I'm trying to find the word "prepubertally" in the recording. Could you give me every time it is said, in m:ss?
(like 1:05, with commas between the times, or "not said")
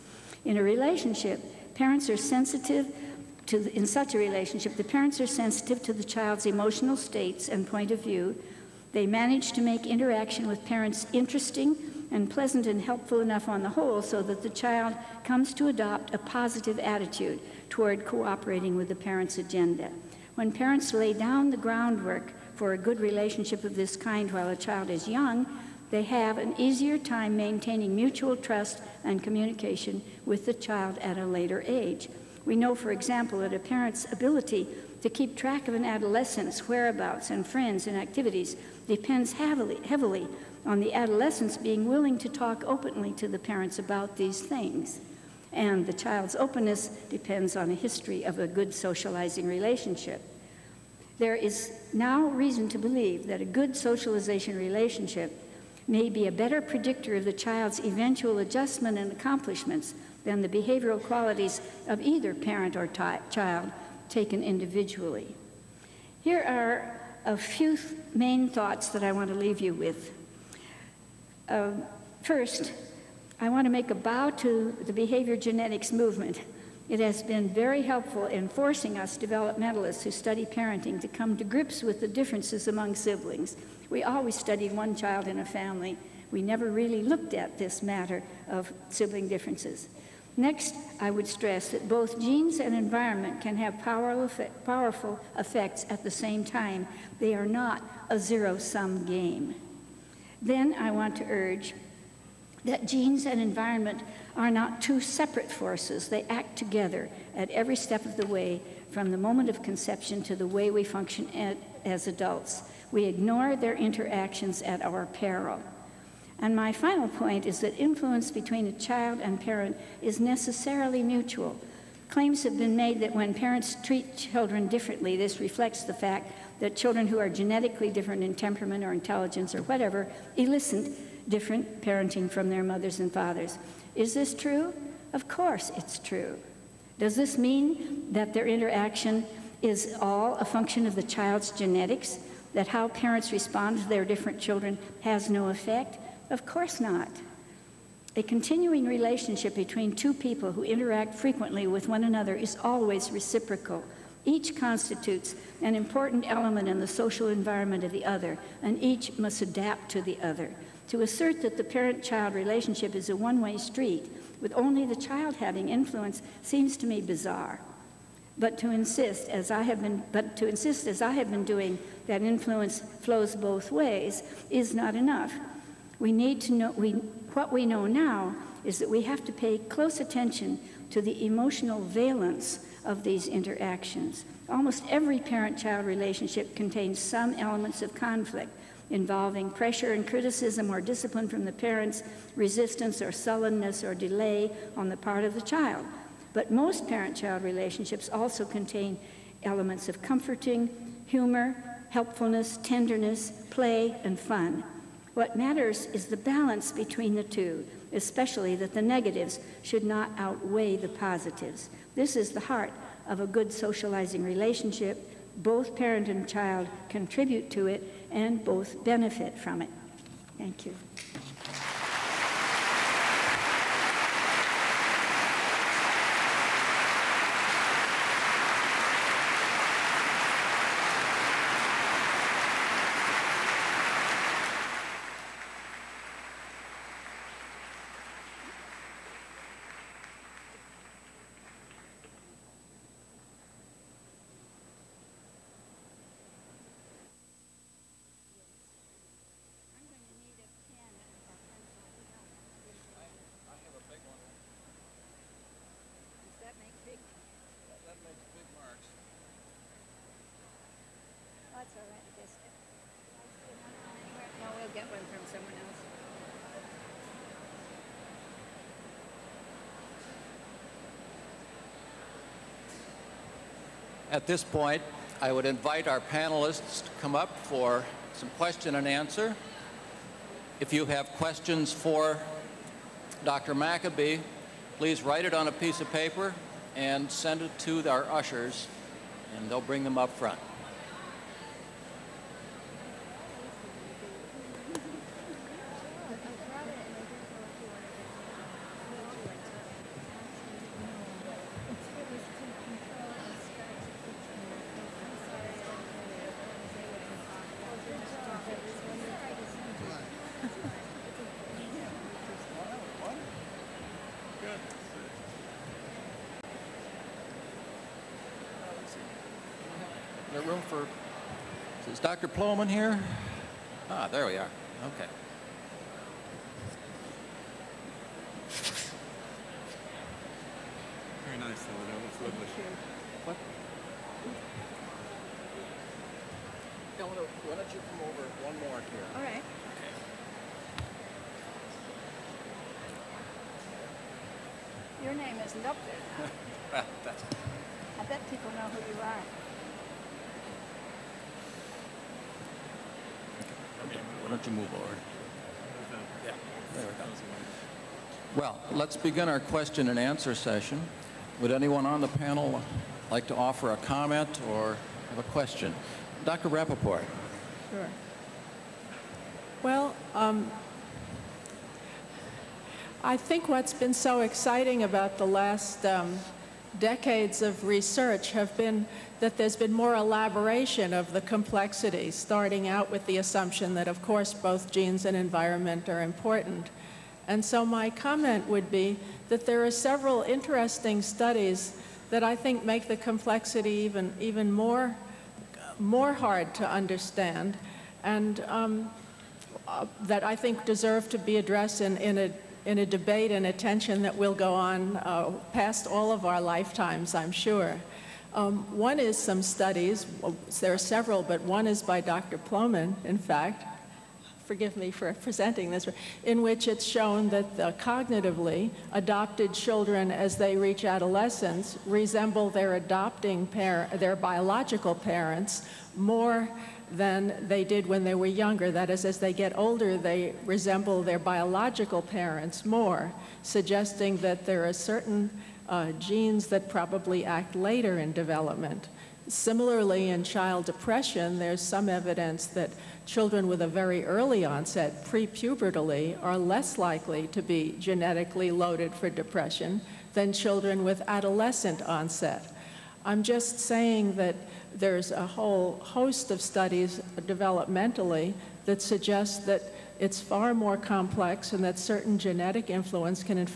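7:25.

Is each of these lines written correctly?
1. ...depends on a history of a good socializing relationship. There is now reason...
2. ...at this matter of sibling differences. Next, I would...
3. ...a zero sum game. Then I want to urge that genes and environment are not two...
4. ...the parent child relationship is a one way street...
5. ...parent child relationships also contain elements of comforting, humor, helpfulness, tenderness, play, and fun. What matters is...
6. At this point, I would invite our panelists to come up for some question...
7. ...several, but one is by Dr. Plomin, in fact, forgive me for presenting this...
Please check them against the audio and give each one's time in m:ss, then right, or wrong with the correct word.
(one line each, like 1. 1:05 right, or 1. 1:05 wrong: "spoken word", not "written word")
1. 0:47 right
2. 1:27 right
3. 1:38 right
4. 2:41 right
5. 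3:16 right
6. 4:34 right
7. 6:50 right.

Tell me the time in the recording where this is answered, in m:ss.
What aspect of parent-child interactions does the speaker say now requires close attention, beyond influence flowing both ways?
3:01.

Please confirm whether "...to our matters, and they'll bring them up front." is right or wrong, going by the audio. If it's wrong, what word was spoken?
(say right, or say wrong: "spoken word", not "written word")
wrong: "ushers", not "matters".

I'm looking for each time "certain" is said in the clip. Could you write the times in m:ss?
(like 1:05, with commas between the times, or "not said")
7:14, 7:41.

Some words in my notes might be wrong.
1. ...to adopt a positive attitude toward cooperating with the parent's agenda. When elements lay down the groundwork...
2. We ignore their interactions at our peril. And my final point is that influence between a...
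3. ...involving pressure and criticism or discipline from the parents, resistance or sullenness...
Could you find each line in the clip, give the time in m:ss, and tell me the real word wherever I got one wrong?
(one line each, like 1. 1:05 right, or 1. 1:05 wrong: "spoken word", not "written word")
1. 0:15 wrong: "parents", not "elements"
2. 1:52 right
3. 3:08 right.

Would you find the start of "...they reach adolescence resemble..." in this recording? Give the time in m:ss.
7:00.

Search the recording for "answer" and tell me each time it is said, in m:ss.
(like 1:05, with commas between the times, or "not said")
4:38, 5:59.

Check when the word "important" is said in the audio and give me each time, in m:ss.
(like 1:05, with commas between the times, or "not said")
2:35, 6:26.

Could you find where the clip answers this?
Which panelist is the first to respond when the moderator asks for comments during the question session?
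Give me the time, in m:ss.
6:06.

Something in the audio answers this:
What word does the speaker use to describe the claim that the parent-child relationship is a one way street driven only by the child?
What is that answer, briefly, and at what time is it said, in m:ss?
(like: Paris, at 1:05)
bizarre, at 2:47.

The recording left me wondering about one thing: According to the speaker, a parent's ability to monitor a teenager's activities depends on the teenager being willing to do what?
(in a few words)
talk openly.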